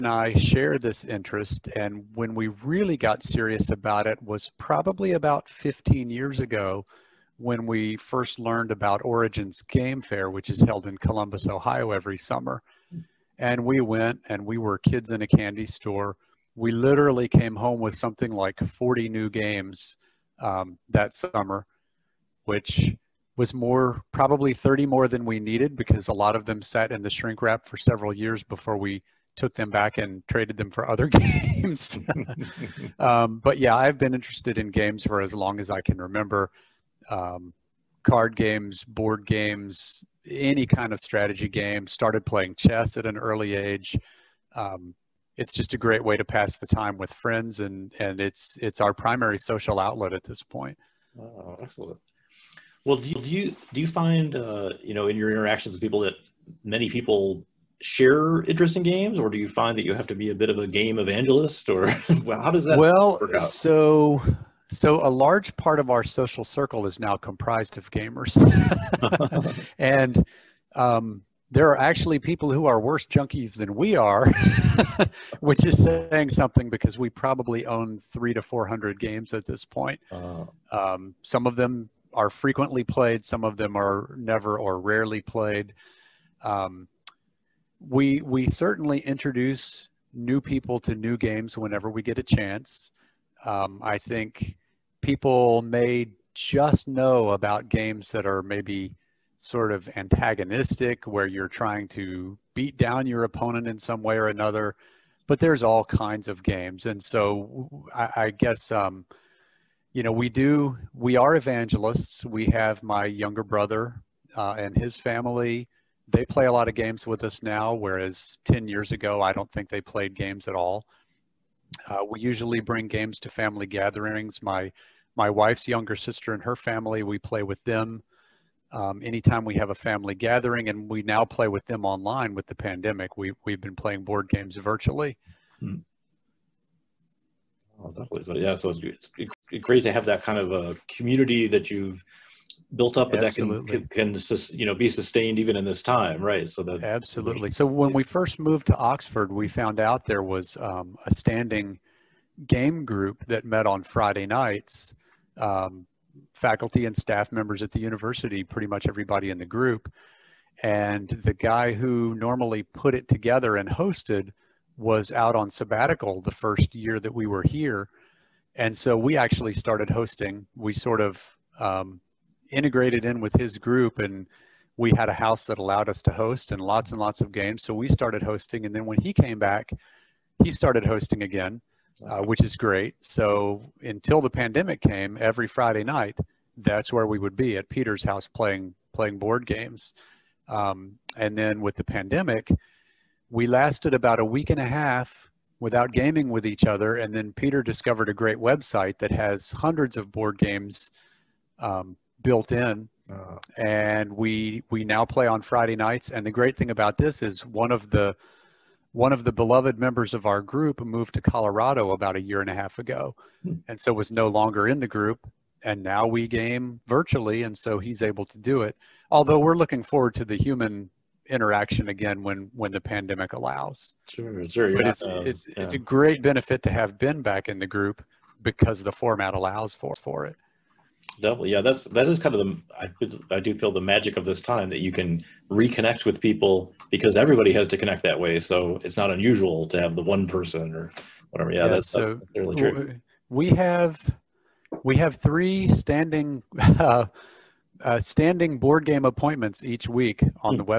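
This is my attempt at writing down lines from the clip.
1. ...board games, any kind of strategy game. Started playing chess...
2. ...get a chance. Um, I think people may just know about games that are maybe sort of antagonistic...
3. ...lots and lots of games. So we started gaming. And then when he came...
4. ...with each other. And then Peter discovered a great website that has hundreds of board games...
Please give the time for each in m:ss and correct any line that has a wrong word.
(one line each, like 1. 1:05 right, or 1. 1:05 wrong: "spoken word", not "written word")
1. 0:38 right
2. 1:32 right
3. 2:56 wrong: "hosting", not "gaming"
4. 3:16 right.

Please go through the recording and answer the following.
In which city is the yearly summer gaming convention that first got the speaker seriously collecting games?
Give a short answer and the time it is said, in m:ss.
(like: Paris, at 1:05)
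Columbus, Ohio, at 0:10.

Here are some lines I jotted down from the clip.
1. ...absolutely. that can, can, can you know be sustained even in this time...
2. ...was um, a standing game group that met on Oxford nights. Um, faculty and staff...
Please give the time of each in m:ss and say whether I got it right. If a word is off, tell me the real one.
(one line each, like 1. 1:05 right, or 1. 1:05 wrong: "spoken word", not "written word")
1. 2:23 right
2. 2:30 wrong: "Friday", not "Oxford".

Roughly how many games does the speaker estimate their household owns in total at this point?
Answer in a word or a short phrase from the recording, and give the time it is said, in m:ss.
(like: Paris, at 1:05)
300 to 400, at 1:17.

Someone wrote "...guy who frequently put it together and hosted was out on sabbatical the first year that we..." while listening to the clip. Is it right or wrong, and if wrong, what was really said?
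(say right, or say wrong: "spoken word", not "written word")
wrong: "normally", not "frequently".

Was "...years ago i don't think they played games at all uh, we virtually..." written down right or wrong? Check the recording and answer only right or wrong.
wrong.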